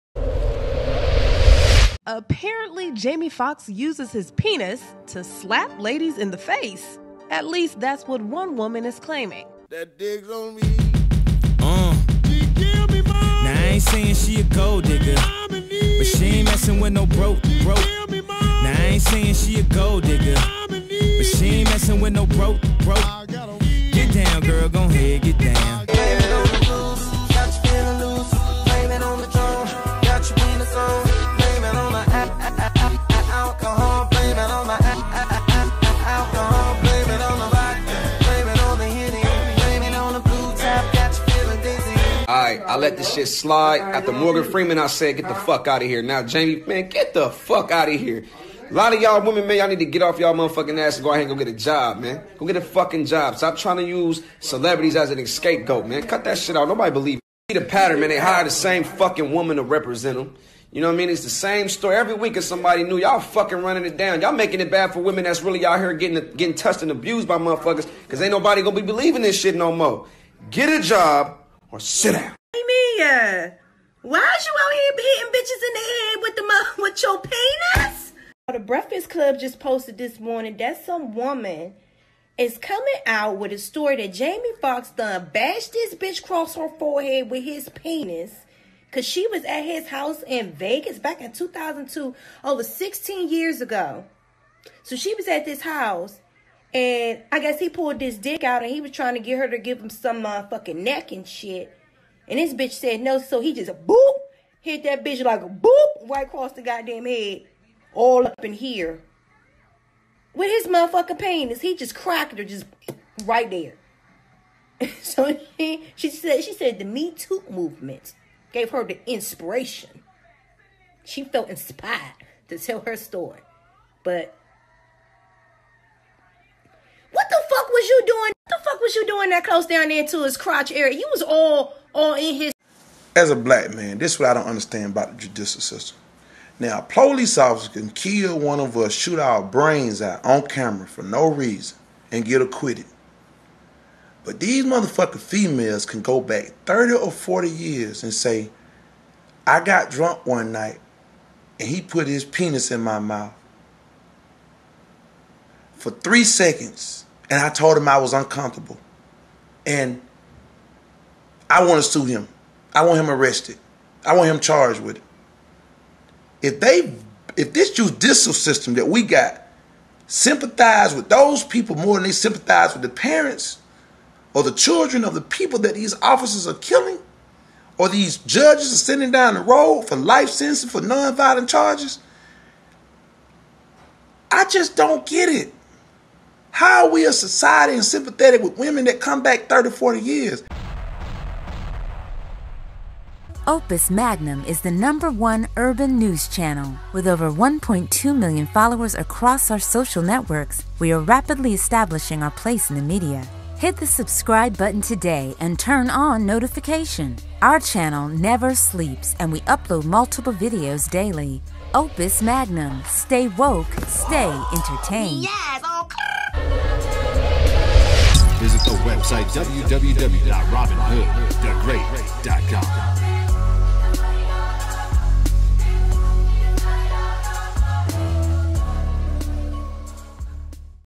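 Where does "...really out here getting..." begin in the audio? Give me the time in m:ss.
1:05.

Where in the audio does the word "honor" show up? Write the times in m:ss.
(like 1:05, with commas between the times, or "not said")
not said.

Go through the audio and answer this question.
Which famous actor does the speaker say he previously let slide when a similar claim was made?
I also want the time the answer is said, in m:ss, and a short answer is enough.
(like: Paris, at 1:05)
Morgan Freeman, at 0:44.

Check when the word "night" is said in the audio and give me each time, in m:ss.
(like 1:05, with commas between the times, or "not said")
2:30.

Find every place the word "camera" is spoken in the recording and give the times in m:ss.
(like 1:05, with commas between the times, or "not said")
2:20.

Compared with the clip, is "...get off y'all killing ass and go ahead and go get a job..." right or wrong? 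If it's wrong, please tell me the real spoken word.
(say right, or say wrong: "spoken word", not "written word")
wrong: "motherfucking", not "killing".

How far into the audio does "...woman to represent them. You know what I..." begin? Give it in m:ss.
0:59.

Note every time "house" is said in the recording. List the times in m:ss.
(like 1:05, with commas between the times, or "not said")
1:29, 1:35.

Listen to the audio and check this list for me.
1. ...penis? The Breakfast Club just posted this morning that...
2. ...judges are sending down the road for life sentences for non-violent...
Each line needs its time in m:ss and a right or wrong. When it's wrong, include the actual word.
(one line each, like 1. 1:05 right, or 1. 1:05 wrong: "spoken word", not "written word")
1. 1:17 right
2. 2:58 right.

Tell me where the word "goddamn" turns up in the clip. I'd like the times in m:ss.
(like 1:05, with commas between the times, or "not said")
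1:46.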